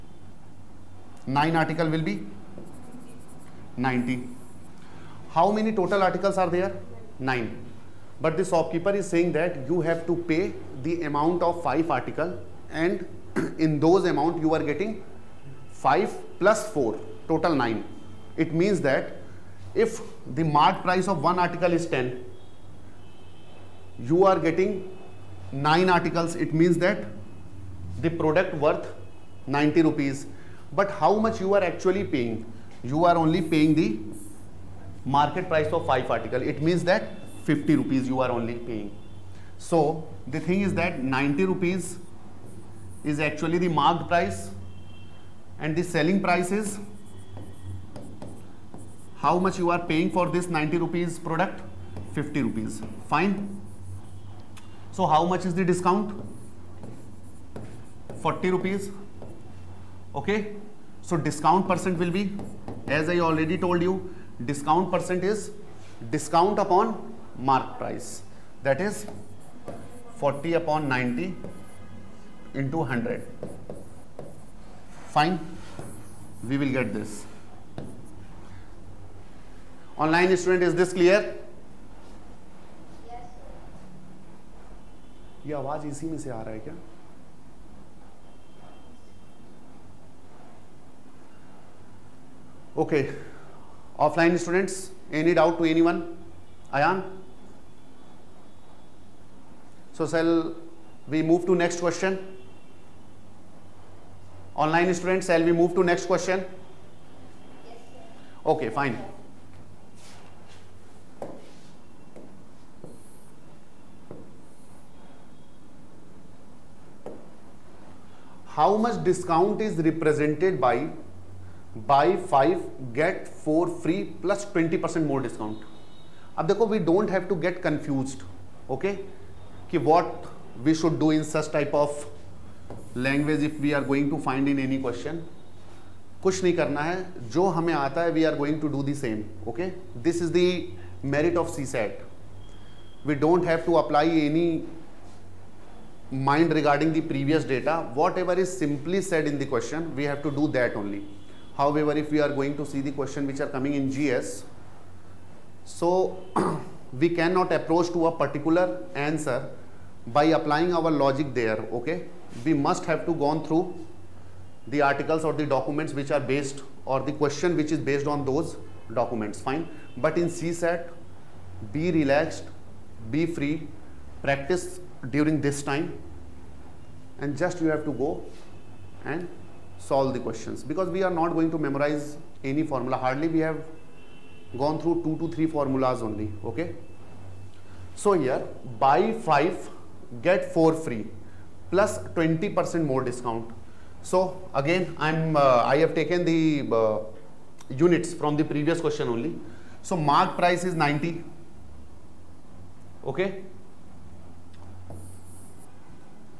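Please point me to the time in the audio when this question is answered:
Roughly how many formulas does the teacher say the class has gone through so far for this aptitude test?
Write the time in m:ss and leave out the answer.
3:05.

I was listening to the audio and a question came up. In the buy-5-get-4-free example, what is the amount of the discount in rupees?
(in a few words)
40 rupees.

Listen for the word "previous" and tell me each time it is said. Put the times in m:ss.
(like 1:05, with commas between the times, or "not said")
3:18.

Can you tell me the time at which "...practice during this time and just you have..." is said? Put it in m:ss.
2:54.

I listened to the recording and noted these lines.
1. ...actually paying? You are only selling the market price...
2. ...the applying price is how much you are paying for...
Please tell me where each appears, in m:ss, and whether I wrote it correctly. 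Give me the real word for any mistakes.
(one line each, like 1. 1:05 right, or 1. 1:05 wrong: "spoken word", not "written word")
1. 0:31 wrong: "paying", not "selling"
2. 0:45 wrong: "selling", not "applying".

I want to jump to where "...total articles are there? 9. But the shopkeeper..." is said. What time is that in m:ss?
0:05.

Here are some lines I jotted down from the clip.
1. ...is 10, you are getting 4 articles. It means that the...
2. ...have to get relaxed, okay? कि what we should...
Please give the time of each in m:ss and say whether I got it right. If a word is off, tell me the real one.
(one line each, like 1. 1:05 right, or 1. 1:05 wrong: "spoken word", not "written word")
1. 0:21 wrong: "9", not "4"
2. 2:07 wrong: "confused", not "relaxed".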